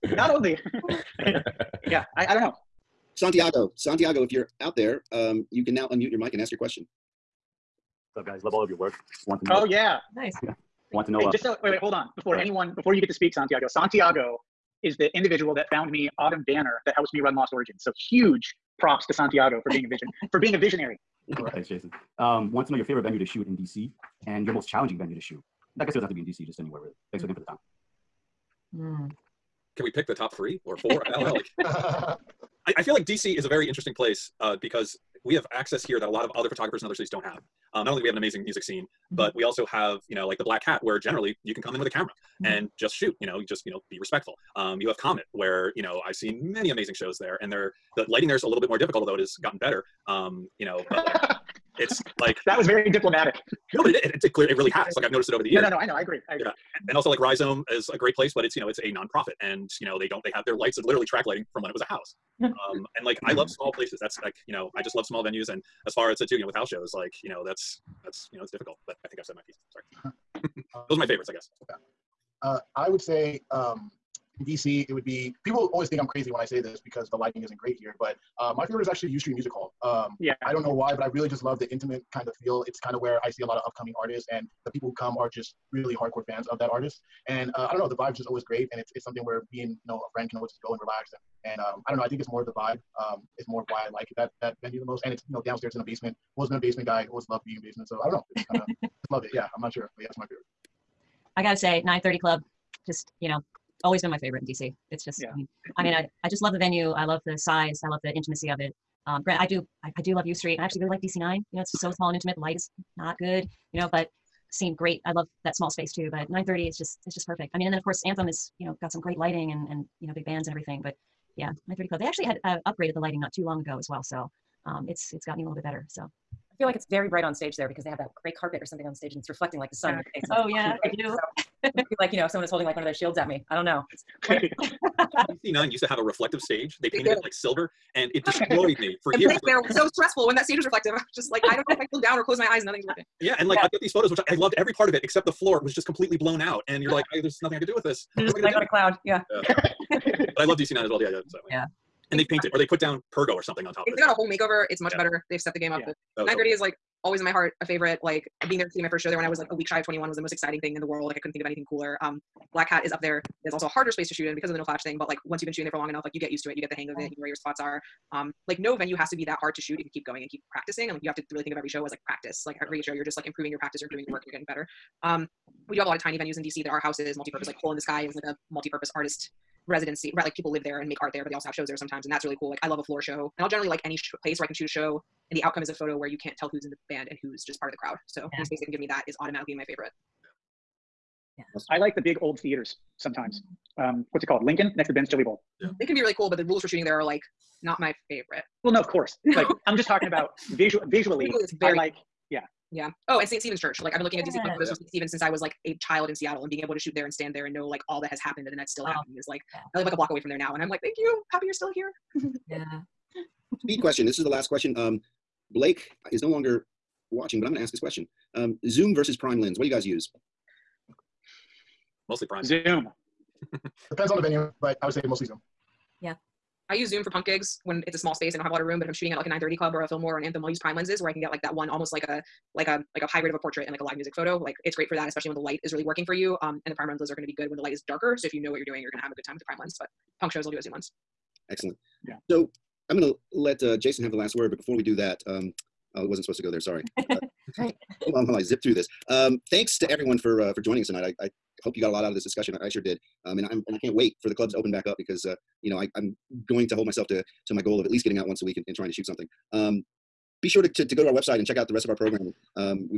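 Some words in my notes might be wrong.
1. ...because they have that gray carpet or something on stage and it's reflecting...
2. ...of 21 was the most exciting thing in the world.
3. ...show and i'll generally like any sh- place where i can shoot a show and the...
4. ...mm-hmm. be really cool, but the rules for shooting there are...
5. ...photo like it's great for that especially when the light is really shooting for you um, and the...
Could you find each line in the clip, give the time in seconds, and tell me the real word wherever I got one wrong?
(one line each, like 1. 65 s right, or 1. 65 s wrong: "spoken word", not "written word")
1. 127 s right
2. 159 s right
3. 183 s right
4. 195 s right
5. 234 s wrong: "working", not "shooting".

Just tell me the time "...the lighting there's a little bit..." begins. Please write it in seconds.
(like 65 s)
47 s.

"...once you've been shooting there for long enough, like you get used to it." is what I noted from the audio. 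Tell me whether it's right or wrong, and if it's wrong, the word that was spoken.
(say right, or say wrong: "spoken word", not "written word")
right.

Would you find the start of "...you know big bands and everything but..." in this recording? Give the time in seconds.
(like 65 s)
120 s.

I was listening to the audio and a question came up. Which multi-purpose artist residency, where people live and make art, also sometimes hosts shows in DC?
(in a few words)
Hole in the Sky.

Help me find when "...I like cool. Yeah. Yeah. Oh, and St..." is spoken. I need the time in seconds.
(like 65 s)
201 s.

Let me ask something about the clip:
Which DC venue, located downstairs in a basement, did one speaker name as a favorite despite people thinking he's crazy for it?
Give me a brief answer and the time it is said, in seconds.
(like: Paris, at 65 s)
U Street Music Hall, at 79 s.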